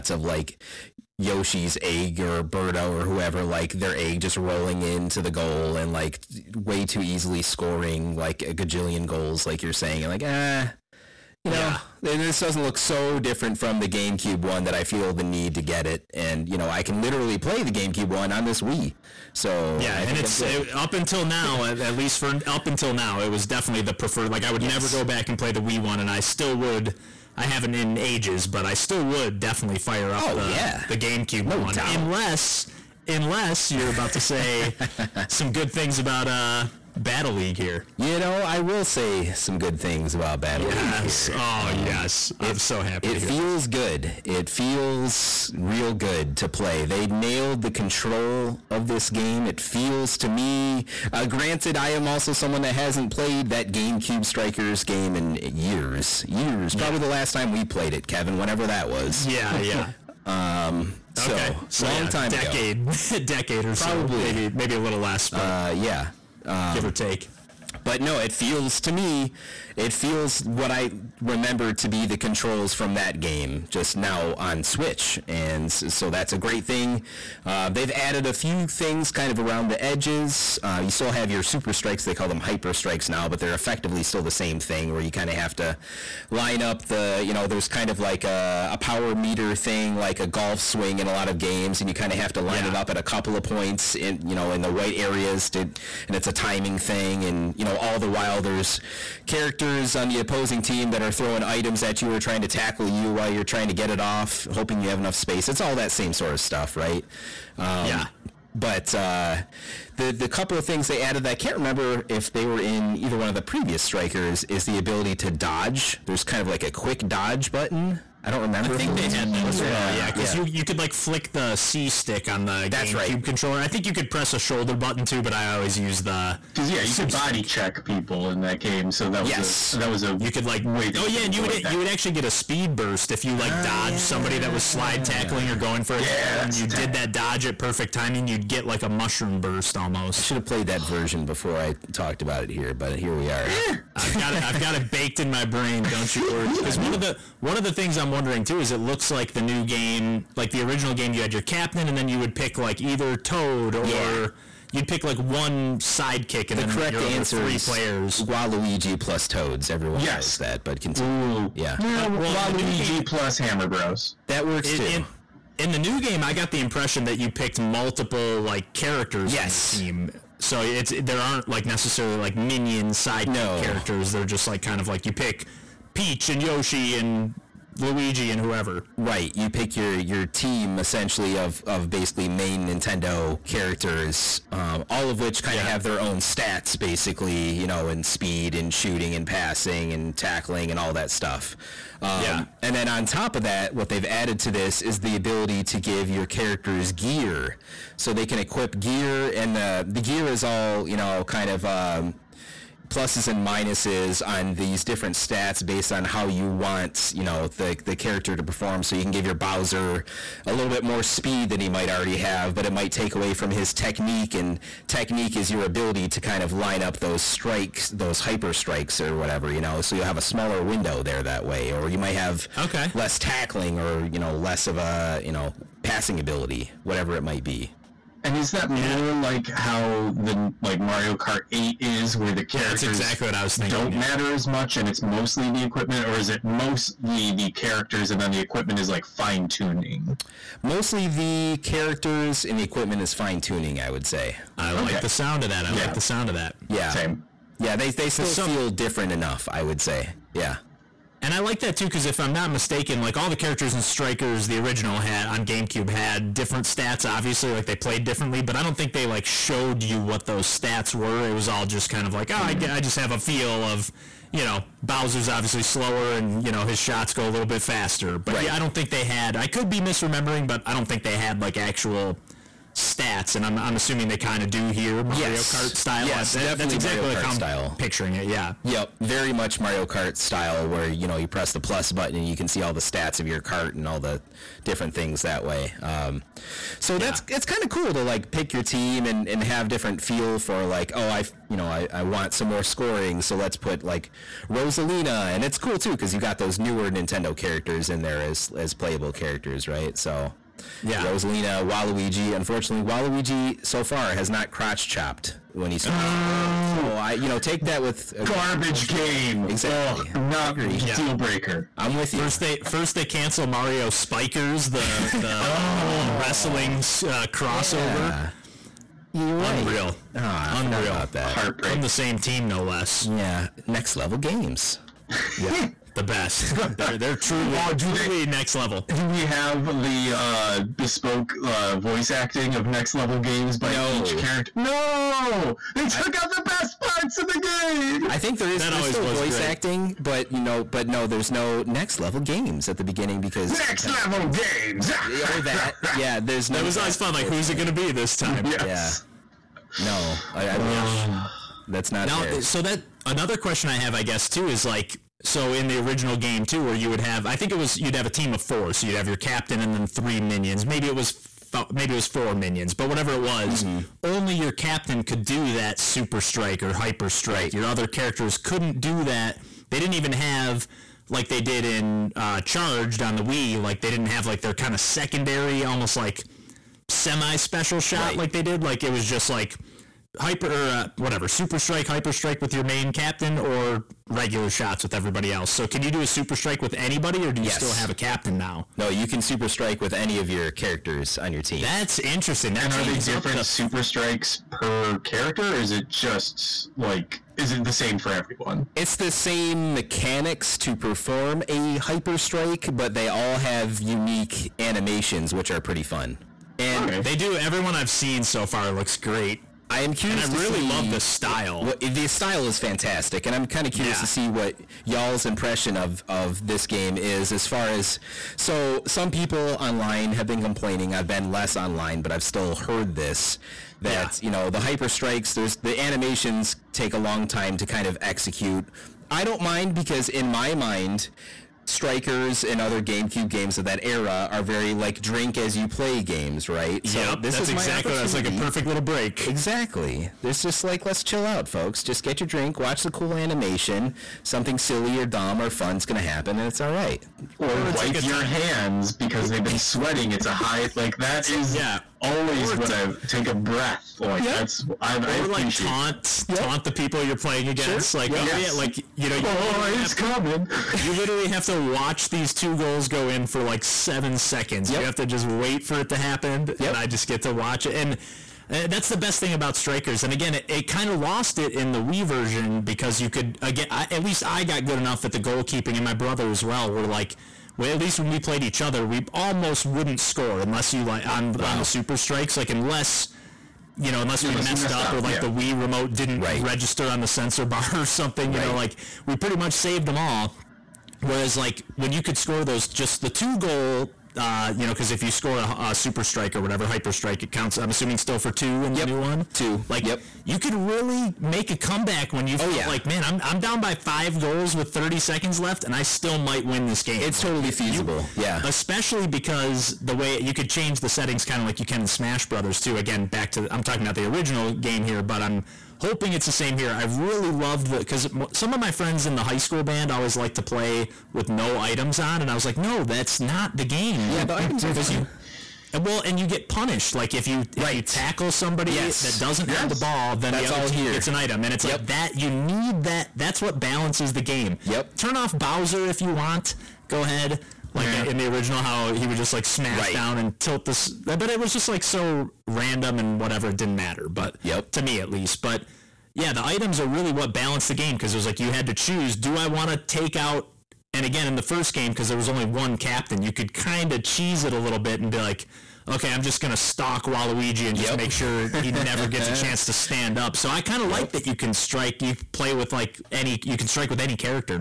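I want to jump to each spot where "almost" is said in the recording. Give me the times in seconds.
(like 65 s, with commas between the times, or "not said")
139 s, 375 s, 479 s.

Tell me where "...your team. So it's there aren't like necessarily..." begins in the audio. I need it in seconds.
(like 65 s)
169 s.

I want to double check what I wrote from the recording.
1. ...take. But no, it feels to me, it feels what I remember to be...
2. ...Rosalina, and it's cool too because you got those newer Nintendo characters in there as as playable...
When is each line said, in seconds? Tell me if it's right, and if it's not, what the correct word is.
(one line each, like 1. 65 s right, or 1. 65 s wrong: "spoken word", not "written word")
1. 66 s right
2. 294 s right.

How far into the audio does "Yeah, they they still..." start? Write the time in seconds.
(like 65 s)
247 s.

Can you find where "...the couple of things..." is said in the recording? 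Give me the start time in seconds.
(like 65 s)
110 s.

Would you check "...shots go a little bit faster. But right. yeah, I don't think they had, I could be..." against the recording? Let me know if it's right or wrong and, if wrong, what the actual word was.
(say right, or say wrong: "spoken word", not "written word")
right.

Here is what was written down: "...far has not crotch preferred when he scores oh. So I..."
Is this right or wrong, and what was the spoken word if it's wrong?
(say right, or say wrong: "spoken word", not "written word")
wrong: "chopped", not "preferred".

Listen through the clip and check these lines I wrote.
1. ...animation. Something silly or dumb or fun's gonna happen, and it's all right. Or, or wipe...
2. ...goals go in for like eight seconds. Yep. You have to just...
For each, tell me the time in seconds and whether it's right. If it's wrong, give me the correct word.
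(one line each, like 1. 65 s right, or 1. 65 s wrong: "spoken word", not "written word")
1. 443 s right
2. 462 s wrong: "seven", not "eight".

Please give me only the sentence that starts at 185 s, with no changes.
have their own stats, basically, you know, and speed and shooting and passing and tackling and all that stuff.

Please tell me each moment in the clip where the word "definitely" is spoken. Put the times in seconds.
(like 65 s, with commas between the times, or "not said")
23 s, 29 s, 276 s.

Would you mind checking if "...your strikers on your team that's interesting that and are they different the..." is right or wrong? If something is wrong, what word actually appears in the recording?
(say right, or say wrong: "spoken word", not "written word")
wrong: "characters", not "strikers".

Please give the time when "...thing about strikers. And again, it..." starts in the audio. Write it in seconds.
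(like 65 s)
469 s.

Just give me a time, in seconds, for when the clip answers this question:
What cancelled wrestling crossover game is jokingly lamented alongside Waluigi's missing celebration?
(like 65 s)
313 s.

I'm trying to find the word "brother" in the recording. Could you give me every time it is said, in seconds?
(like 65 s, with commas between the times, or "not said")
475 s, 512 s.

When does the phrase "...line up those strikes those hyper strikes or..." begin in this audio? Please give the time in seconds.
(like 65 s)
216 s.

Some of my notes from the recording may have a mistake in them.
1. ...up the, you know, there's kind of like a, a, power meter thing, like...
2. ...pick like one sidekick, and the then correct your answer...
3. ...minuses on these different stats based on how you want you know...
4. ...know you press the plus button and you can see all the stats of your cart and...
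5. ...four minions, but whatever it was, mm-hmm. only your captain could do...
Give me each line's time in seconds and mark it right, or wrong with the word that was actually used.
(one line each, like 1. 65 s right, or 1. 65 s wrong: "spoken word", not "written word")
1. 86 s right
2. 154 s right
3. 203 s right
4. 281 s right
5. 362 s right.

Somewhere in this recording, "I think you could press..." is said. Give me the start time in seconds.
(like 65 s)
123 s.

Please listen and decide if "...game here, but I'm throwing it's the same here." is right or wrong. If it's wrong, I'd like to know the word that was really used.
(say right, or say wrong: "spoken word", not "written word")
wrong: "hoping", not "throwing".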